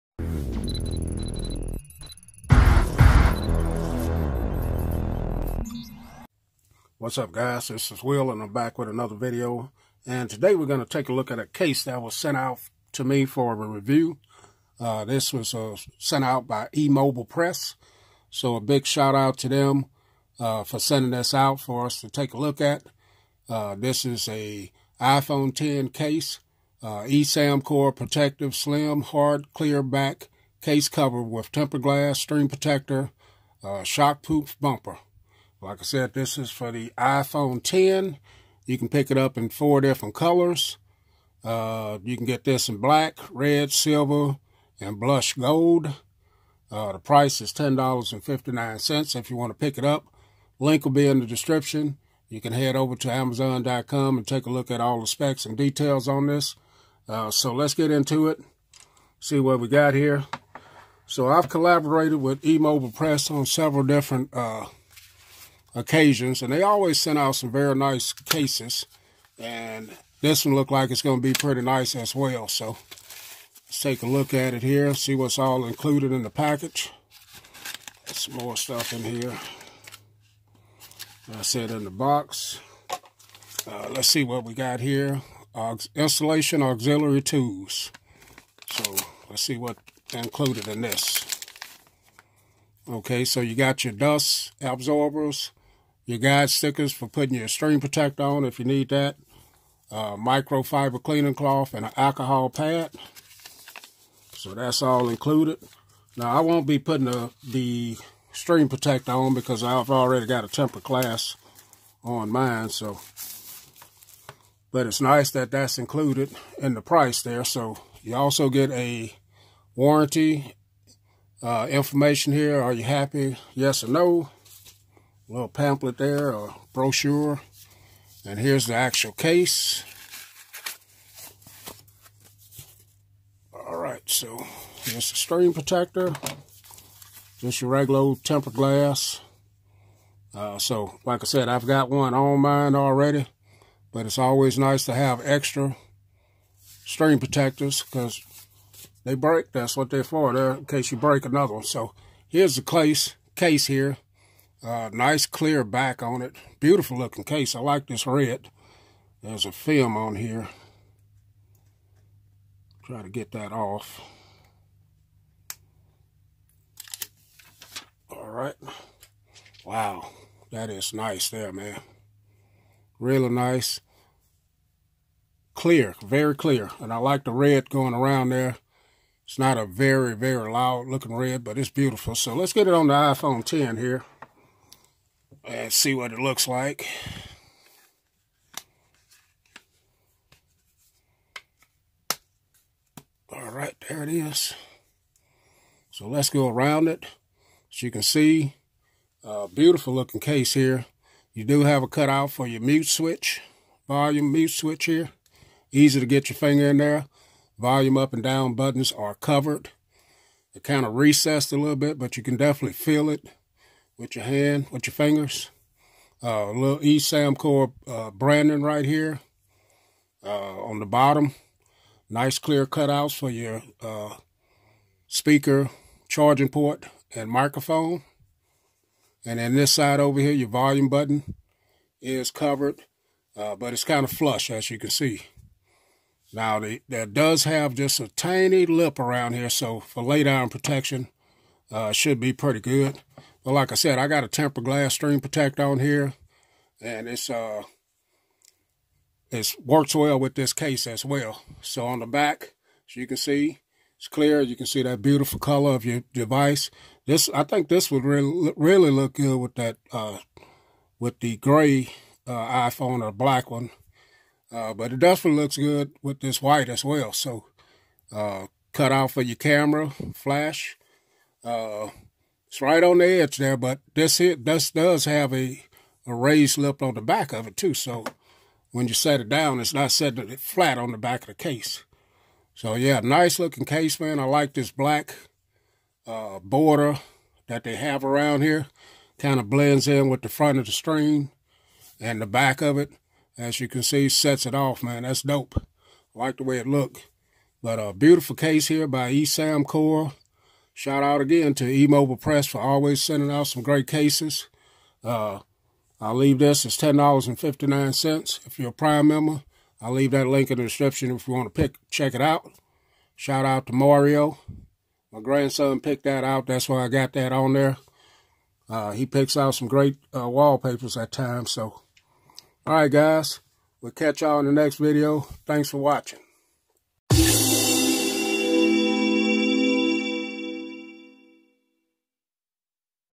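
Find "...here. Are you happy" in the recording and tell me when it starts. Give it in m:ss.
2:02.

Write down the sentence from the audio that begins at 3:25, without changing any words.
Easy to get your finger in there.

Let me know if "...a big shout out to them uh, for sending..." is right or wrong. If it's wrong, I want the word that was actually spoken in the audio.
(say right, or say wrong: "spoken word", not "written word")
right.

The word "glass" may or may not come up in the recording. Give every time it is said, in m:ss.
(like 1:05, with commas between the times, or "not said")
0:31, 1:50, 2:18, 4:04.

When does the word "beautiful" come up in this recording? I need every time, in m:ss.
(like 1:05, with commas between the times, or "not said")
2:36, 3:01, 3:19, 4:15, 4:57.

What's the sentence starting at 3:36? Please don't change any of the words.
Uh, little eSamcore uh, branding right here uh, on the bottom.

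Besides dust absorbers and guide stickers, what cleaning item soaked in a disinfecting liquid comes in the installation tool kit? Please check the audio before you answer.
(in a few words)
alcohol pad.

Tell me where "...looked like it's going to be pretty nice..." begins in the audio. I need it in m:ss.
1:10.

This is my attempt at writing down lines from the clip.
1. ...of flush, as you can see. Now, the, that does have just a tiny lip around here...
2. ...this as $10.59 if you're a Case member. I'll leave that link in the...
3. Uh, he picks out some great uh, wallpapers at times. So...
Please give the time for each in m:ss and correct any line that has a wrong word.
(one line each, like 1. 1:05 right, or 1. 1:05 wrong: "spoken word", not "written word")
1. 3:54 right
2. 5:06 wrong: "Prime", not "Case"
3. 5:18 right.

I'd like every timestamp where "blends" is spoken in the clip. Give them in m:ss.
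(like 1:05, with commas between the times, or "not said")
4:49.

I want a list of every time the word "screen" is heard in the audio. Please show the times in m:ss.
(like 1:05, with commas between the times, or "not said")
0:32, 2:15, 2:26.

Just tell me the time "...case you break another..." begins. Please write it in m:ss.
2:30.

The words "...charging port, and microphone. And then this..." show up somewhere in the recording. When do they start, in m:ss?
3:46.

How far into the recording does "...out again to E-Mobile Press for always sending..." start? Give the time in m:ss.
5:01.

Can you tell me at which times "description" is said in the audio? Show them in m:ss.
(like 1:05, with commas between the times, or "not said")
0:51, 5:10.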